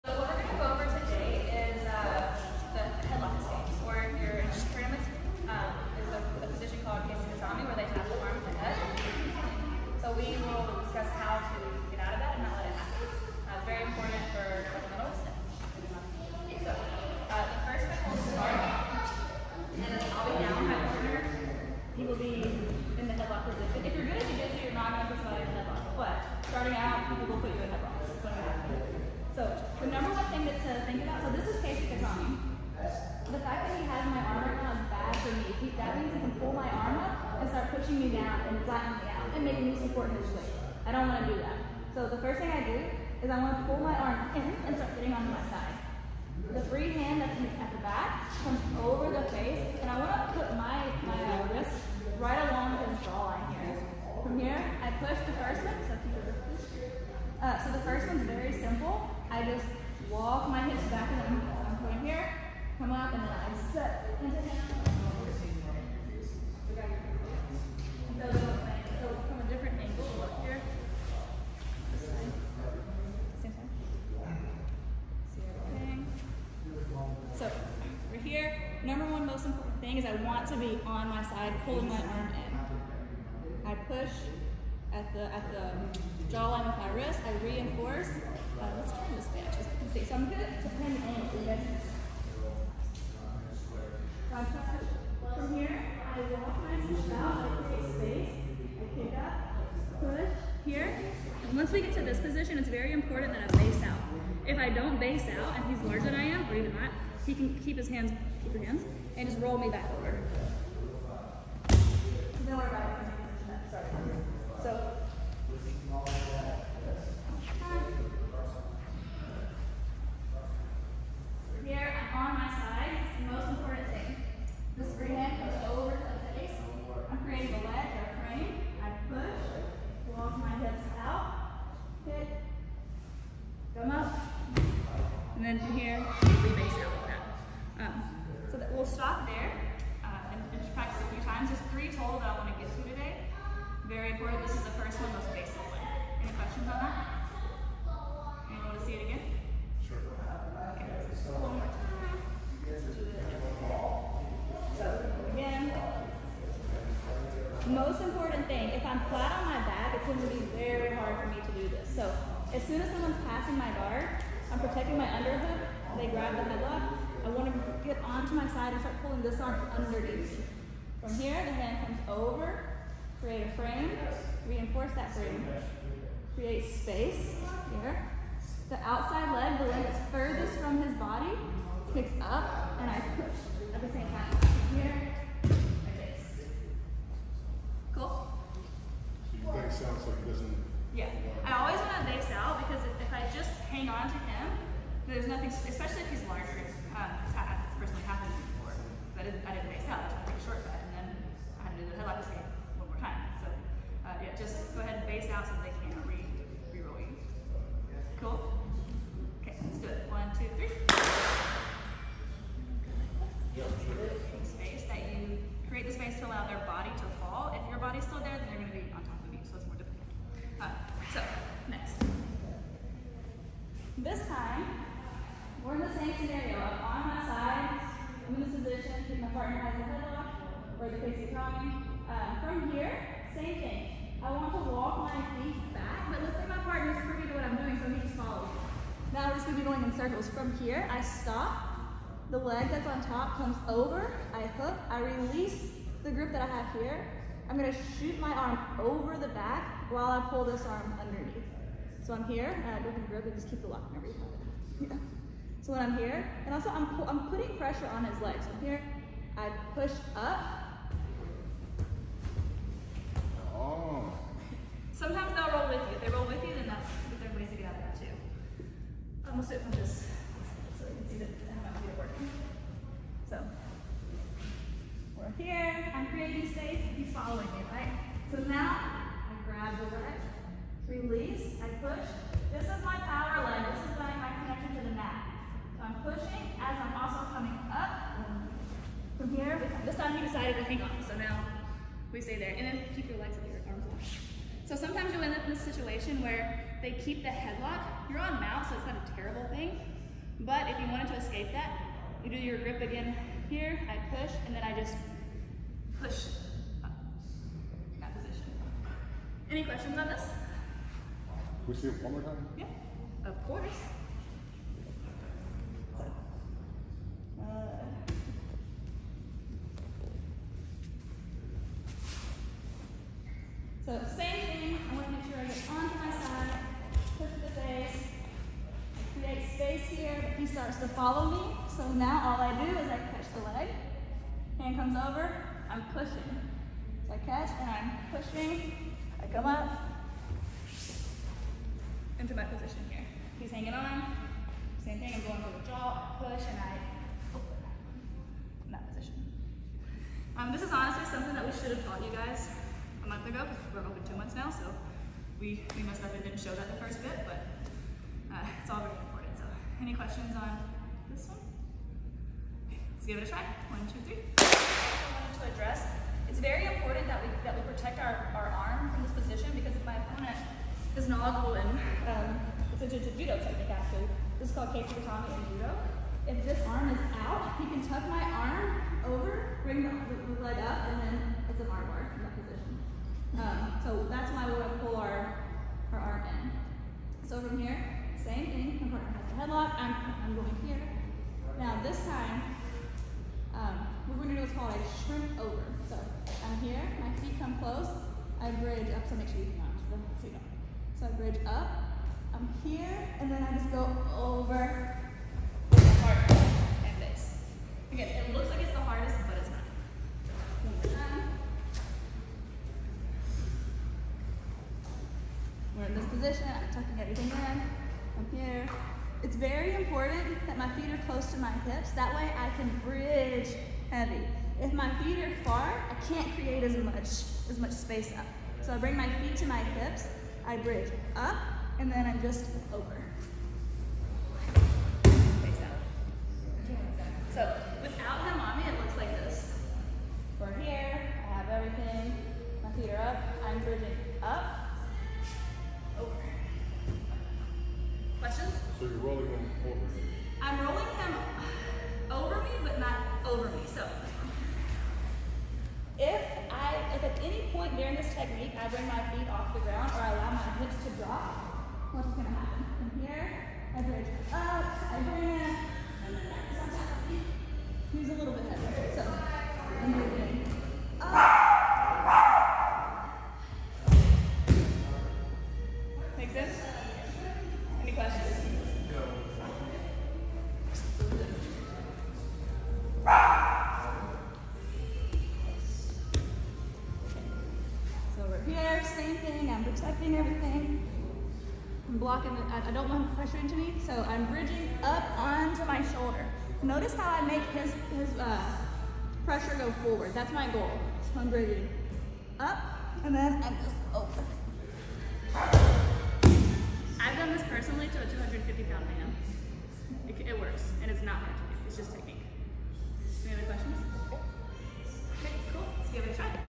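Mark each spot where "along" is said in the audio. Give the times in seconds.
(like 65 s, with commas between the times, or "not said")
52 s.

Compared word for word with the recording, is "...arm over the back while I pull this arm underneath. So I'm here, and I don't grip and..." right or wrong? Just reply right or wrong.
right.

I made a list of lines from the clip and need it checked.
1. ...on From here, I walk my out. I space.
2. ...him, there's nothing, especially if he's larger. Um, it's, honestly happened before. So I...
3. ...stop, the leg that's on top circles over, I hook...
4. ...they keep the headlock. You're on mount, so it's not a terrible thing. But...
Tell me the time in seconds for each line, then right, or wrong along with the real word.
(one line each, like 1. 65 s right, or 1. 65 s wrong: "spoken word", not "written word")
1. 94 s right
2. 194 s wrong: "personally", not "honestly"
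3. 241 s wrong: "comes", not "circles"
4. 296 s right.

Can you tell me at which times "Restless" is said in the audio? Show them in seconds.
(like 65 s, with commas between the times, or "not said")
not said.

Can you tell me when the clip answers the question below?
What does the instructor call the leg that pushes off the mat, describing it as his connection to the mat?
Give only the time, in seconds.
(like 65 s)
283 s.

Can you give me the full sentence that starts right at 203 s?
So uh, yeah, just go ahead and base out so they can't re re-roll you.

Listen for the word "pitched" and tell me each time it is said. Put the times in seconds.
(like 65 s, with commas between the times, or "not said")
not said.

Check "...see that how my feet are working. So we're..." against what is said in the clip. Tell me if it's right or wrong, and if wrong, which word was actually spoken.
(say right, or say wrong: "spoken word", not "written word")
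right.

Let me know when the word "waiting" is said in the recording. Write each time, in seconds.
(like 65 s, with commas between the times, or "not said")
not said.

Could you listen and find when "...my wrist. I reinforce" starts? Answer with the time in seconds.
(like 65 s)
86 s.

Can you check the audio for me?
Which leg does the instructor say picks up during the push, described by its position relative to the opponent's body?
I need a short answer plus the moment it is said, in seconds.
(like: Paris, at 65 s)
the outside leg, at 178 s.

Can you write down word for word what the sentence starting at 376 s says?
If this arm is out, he can tuck my arm over, bring the, the leg up, and then it's an arm bar.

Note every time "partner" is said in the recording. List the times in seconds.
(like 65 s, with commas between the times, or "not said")
229 s, 236 s, 388 s.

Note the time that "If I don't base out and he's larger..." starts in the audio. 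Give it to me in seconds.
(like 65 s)
104 s.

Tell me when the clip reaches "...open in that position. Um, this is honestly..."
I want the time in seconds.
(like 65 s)
347 s.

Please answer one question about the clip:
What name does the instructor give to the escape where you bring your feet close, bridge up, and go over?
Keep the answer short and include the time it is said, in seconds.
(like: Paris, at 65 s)
shrimp over, at 395 s.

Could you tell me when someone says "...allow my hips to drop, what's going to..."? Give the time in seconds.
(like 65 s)
460 s.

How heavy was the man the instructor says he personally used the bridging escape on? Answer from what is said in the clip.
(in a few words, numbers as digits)
250 pounds.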